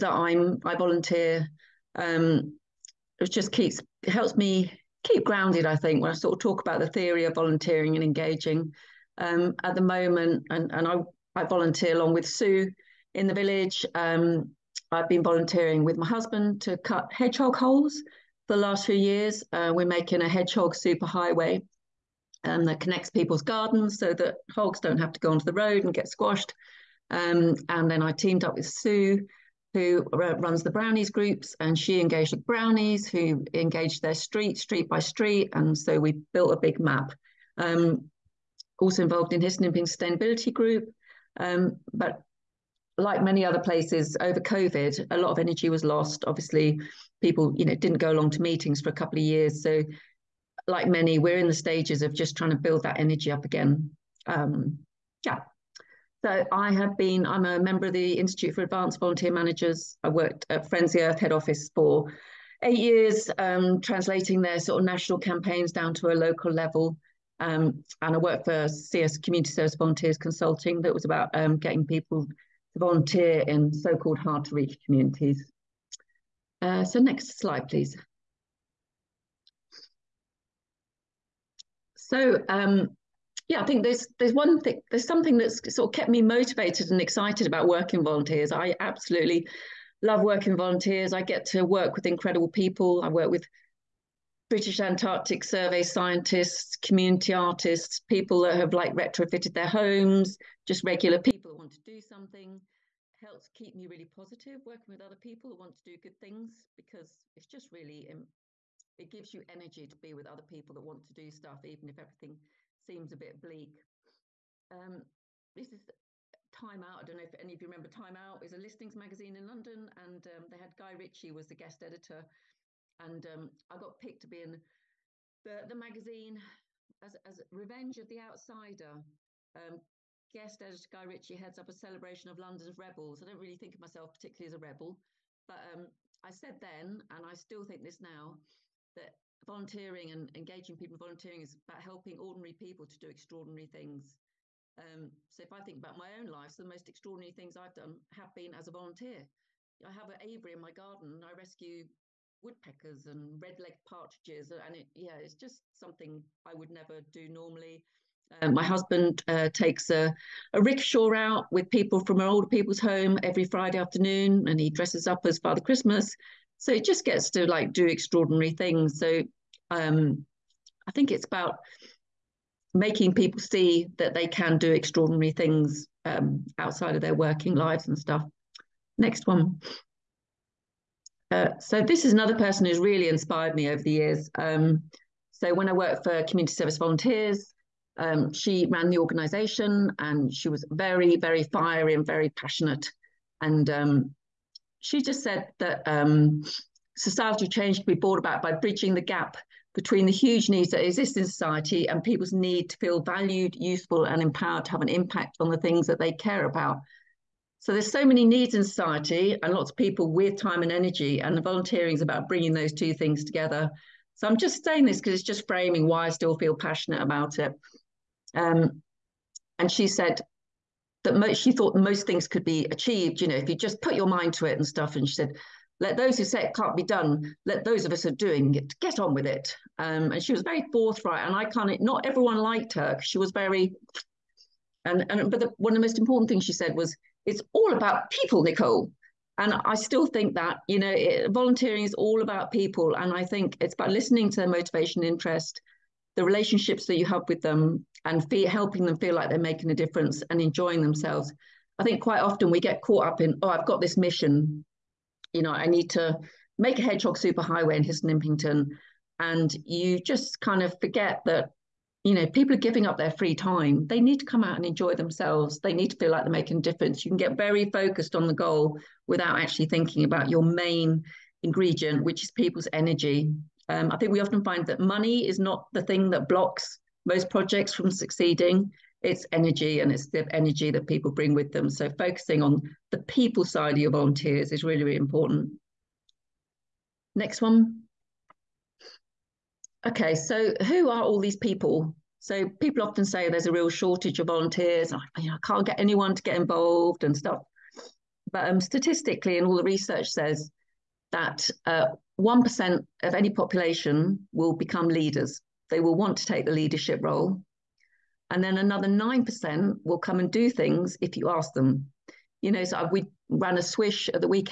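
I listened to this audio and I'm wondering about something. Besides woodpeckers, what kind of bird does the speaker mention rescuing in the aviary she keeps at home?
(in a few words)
red-legged partridges.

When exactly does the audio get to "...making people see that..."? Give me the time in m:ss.
2:52.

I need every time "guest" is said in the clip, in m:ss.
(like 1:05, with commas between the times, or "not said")
2:01, 2:10.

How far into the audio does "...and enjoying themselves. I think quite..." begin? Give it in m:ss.
4:10.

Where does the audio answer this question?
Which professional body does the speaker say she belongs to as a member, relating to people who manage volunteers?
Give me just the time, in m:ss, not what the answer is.
0:58.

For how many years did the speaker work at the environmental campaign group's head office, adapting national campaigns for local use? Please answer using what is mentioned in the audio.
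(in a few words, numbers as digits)
8.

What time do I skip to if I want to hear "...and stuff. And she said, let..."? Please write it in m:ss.
3:44.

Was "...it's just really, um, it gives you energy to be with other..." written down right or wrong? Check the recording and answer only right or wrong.
right.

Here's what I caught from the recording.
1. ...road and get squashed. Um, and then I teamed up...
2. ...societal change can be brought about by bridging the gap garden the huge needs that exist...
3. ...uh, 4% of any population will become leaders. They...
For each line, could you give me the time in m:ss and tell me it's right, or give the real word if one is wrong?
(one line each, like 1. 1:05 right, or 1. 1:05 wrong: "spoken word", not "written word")
1. 0:25 right
2. 3:16 wrong: "between", not "garden"
3. 5:01 wrong: "1", not "4".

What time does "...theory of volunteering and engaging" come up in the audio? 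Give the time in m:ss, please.
0:06.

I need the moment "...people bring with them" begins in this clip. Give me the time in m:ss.
4:40.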